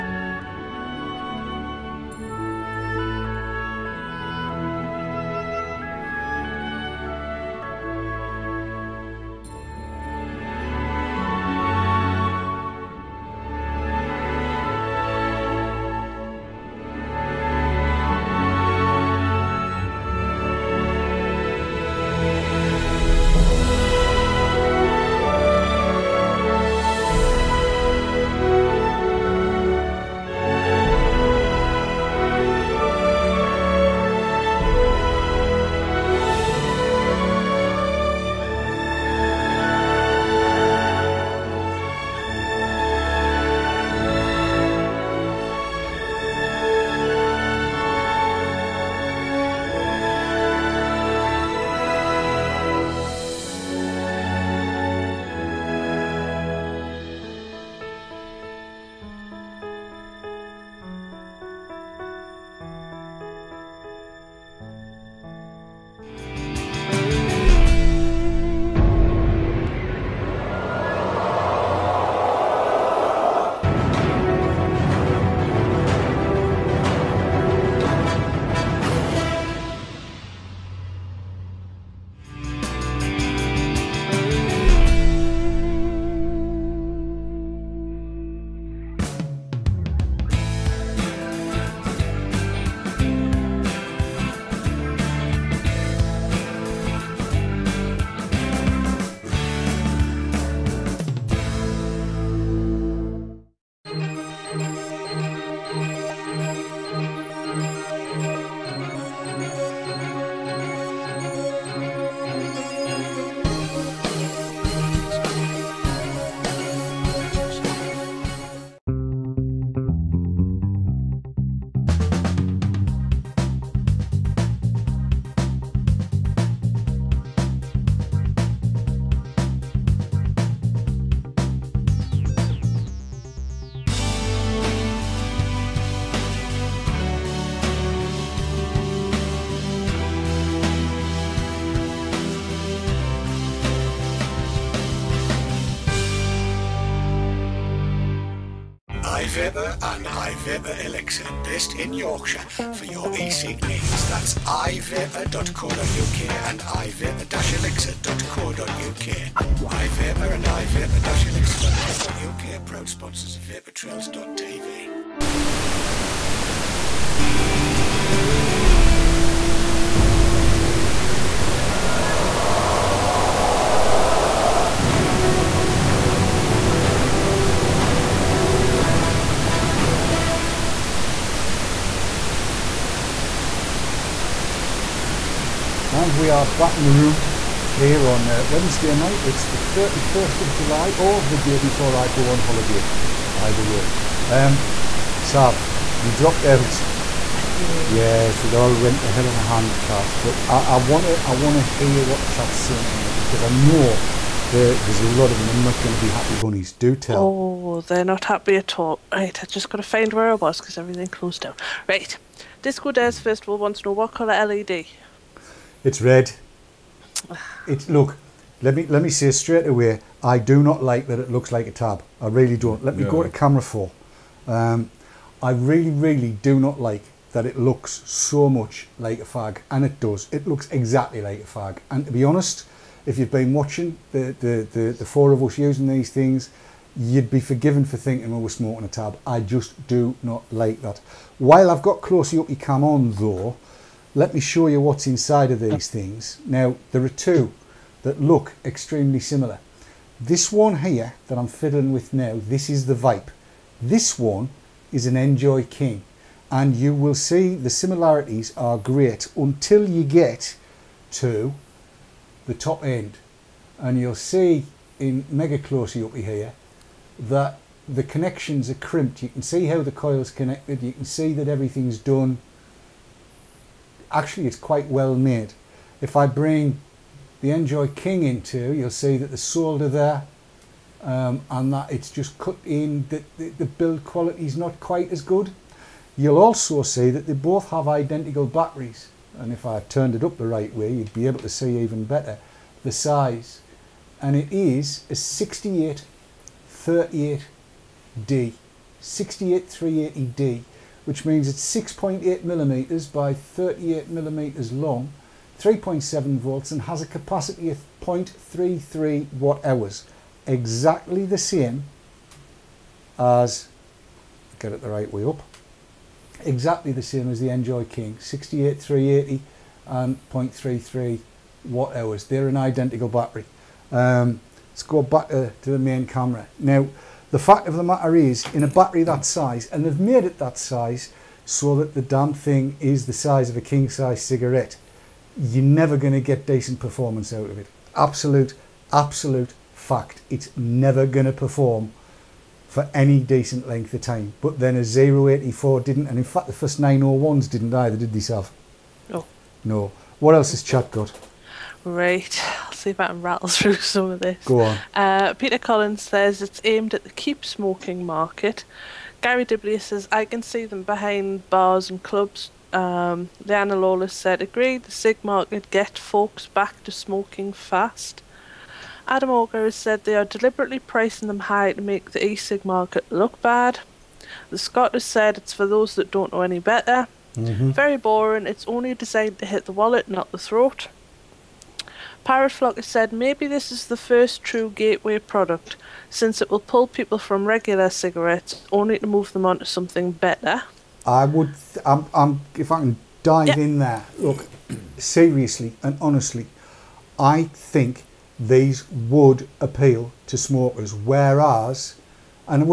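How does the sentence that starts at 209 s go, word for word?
Right, I just got to find where I was because everything closed down.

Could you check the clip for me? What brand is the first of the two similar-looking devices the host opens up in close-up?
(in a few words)
Vype.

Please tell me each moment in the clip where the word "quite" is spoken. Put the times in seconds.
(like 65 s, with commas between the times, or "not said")
274 s, 284 s.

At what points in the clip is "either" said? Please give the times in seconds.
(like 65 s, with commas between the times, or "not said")
193 s, 347 s.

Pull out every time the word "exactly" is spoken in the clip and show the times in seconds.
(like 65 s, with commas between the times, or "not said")
230 s, 310 s, 316 s.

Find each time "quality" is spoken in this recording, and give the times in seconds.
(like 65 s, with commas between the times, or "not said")
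284 s.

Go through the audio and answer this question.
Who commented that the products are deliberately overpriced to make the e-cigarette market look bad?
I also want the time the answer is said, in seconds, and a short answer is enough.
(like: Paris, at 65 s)
Adam Auger, at 369 s.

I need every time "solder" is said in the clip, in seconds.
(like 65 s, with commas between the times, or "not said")
279 s.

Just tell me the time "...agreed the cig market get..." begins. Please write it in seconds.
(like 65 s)
364 s.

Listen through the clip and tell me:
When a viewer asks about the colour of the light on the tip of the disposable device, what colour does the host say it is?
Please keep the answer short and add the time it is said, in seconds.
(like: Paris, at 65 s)
red, at 215 s.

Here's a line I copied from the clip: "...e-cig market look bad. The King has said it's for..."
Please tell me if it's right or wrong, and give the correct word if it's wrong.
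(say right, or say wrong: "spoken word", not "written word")
wrong: "Scot", not "King".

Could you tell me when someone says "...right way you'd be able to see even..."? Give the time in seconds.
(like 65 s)
290 s.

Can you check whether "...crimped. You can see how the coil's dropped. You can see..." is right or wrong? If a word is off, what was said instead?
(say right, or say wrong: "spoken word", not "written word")
wrong: "connected", not "dropped".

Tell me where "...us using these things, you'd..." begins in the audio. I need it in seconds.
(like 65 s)
235 s.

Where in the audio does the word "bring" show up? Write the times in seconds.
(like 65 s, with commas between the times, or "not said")
276 s.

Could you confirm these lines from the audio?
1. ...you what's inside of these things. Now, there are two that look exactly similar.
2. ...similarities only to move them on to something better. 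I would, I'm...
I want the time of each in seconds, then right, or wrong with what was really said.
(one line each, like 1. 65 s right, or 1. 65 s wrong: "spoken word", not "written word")
1. 244 s wrong: "extremely", not "exactly"
2. 387 s wrong: "cigarettes", not "similarities".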